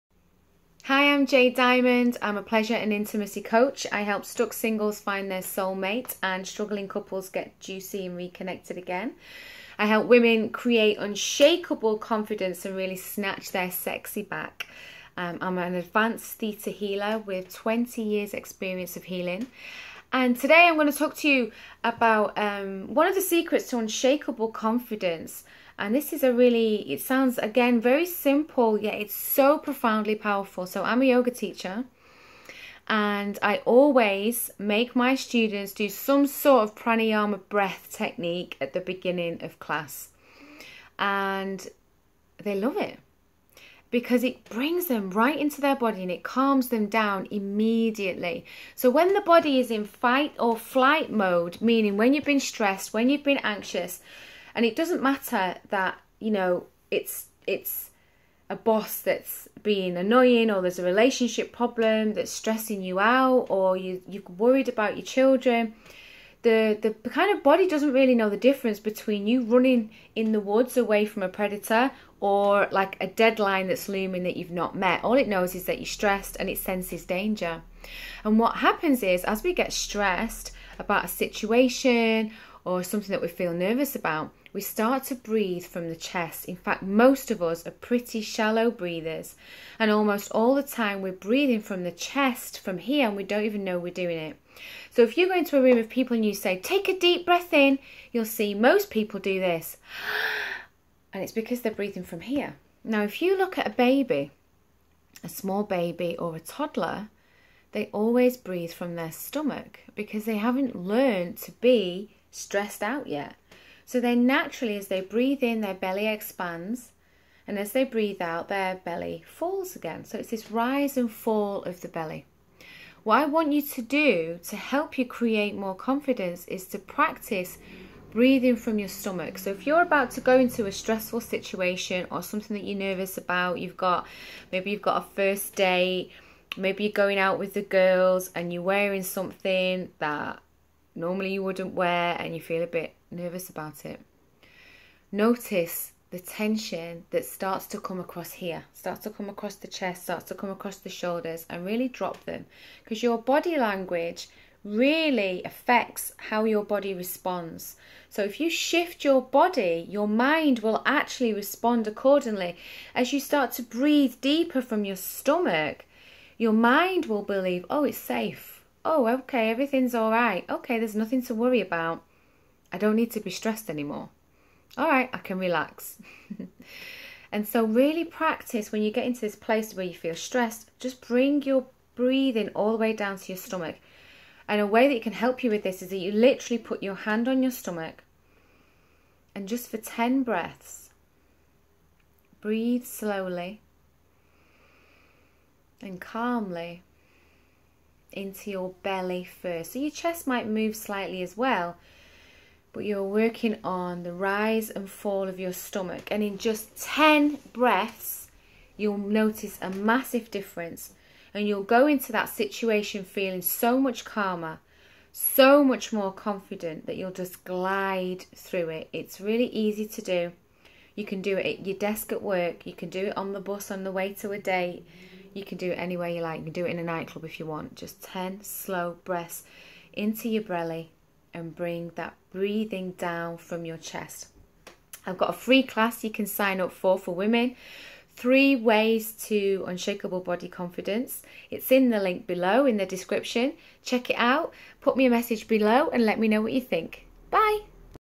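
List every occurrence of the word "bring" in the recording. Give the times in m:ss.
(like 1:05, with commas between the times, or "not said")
0:44, 3:01, 3:51.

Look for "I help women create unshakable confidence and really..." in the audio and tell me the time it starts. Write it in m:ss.
0:09.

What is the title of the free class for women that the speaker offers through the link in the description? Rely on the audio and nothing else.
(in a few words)
Three ways to unshakable body confidence.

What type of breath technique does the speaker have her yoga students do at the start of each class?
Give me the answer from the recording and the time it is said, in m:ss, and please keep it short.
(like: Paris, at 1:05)
pranayama, at 0:36.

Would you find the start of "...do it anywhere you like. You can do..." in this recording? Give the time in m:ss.
3:45.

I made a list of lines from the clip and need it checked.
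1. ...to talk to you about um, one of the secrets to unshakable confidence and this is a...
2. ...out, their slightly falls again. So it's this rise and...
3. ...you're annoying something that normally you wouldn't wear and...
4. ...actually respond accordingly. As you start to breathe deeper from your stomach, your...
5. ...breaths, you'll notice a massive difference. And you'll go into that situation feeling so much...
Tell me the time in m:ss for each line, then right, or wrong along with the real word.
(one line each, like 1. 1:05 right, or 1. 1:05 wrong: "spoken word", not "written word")
1. 0:20 right
2. 1:58 wrong: "belly", not "slightly"
3. 2:18 wrong: "wearing", not "annoying"
4. 2:40 right
5. 3:27 right.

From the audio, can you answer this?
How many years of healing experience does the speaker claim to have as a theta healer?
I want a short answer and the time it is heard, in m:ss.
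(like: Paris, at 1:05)
20, at 0:17.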